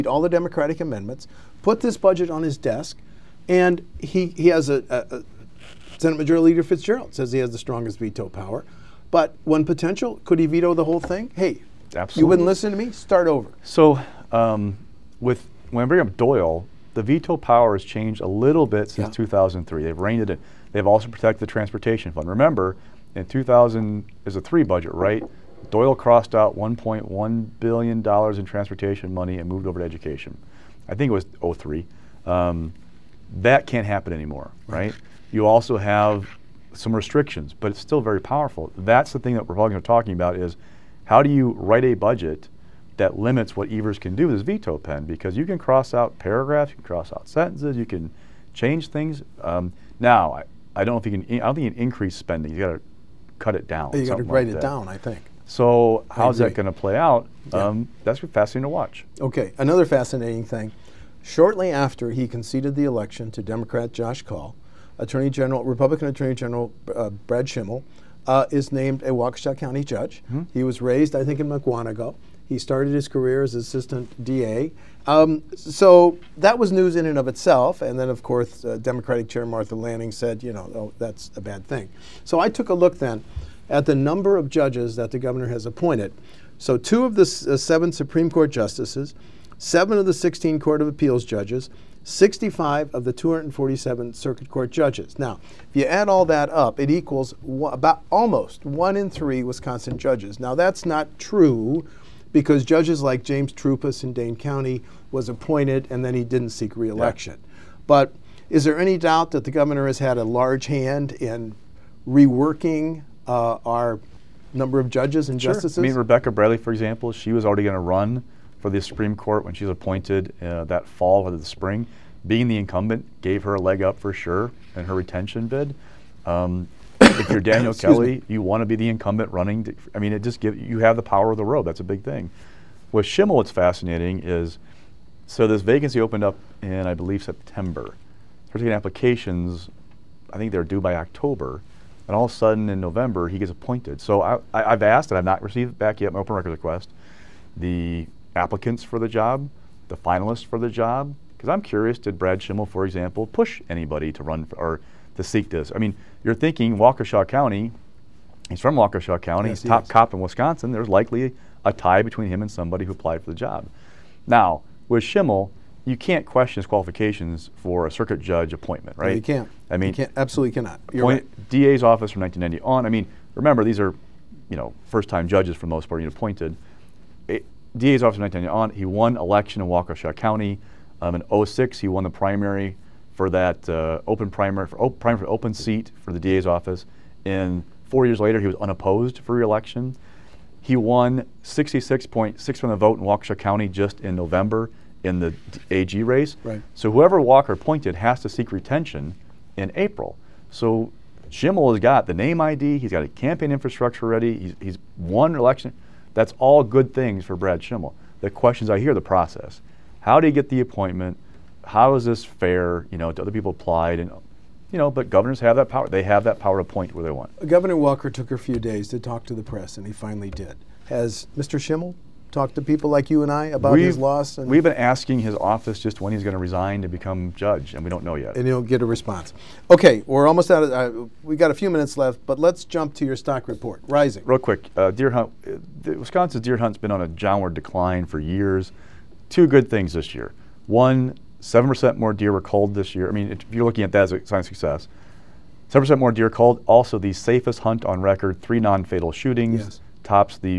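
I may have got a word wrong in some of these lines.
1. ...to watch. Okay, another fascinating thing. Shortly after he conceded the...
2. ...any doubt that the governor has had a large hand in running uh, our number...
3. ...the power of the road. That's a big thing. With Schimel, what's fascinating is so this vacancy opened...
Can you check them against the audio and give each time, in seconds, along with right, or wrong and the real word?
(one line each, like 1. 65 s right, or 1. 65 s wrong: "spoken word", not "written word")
1. 58 s right
2. 108 s wrong: "reworking", not "running"
3. 130 s right.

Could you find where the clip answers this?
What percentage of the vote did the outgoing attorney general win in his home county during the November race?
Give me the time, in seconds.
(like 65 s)
191 s.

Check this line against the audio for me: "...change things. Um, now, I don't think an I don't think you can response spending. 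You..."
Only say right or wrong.
wrong.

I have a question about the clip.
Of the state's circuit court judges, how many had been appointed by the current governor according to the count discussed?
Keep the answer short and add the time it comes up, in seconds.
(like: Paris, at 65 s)
65, at 92 s.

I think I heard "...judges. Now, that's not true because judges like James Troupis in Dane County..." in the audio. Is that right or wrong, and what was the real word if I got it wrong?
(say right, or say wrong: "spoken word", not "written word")
right.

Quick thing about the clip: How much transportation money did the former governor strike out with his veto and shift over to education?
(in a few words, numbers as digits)
1.1 billion dollars.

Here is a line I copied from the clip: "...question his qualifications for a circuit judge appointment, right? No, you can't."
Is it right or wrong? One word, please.
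right.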